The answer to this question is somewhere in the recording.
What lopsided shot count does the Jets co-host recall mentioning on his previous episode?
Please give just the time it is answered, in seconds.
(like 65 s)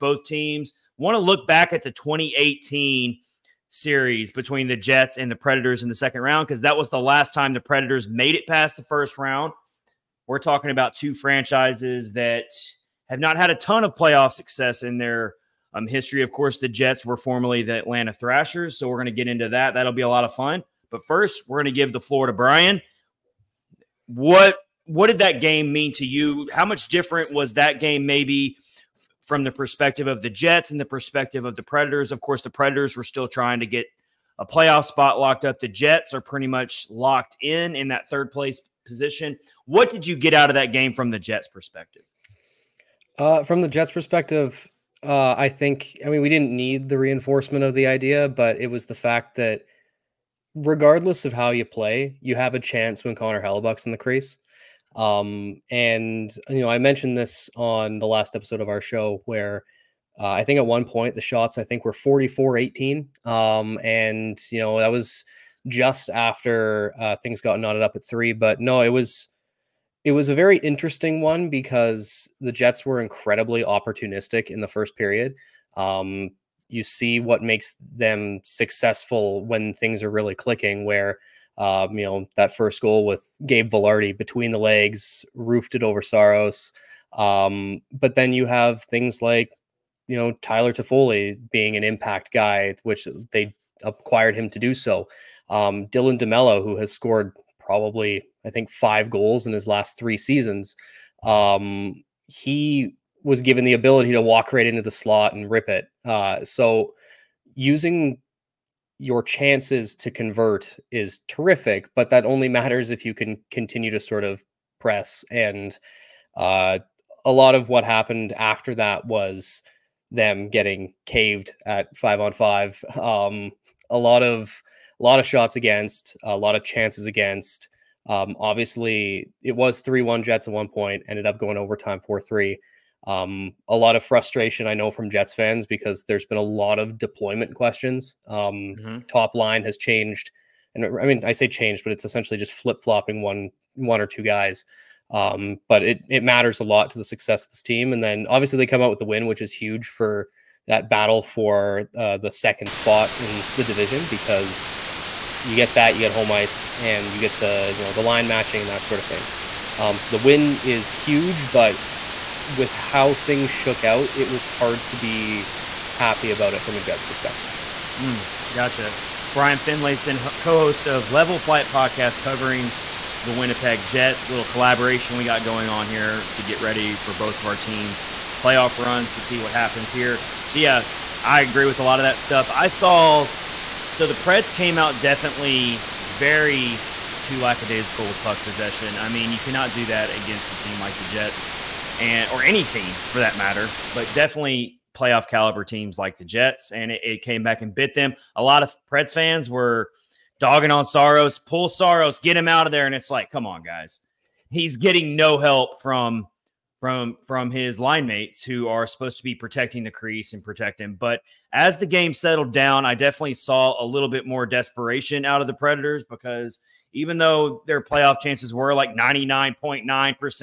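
61 s.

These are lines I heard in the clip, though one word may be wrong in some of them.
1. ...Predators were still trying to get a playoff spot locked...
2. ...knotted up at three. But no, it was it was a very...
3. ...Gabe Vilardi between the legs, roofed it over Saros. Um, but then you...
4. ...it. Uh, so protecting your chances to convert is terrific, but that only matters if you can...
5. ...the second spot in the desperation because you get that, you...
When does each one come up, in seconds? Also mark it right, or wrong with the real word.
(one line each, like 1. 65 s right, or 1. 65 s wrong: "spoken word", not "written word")
1. 32 s right
2. 67 s right
3. 83 s right
4. 105 s wrong: "using", not "protecting"
5. 152 s wrong: "division", not "desperation".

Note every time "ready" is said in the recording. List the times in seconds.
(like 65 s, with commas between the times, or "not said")
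176 s.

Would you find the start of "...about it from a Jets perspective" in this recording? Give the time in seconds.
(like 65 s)
166 s.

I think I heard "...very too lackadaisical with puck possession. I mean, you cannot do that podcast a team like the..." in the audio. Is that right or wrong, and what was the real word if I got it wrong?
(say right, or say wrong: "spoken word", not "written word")
wrong: "against", not "podcast".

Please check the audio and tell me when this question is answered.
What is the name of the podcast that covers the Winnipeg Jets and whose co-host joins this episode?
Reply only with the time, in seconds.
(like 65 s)
171 s.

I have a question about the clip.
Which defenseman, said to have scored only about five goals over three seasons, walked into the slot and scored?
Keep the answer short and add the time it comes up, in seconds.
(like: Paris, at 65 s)
Dylan DeMello, at 95 s.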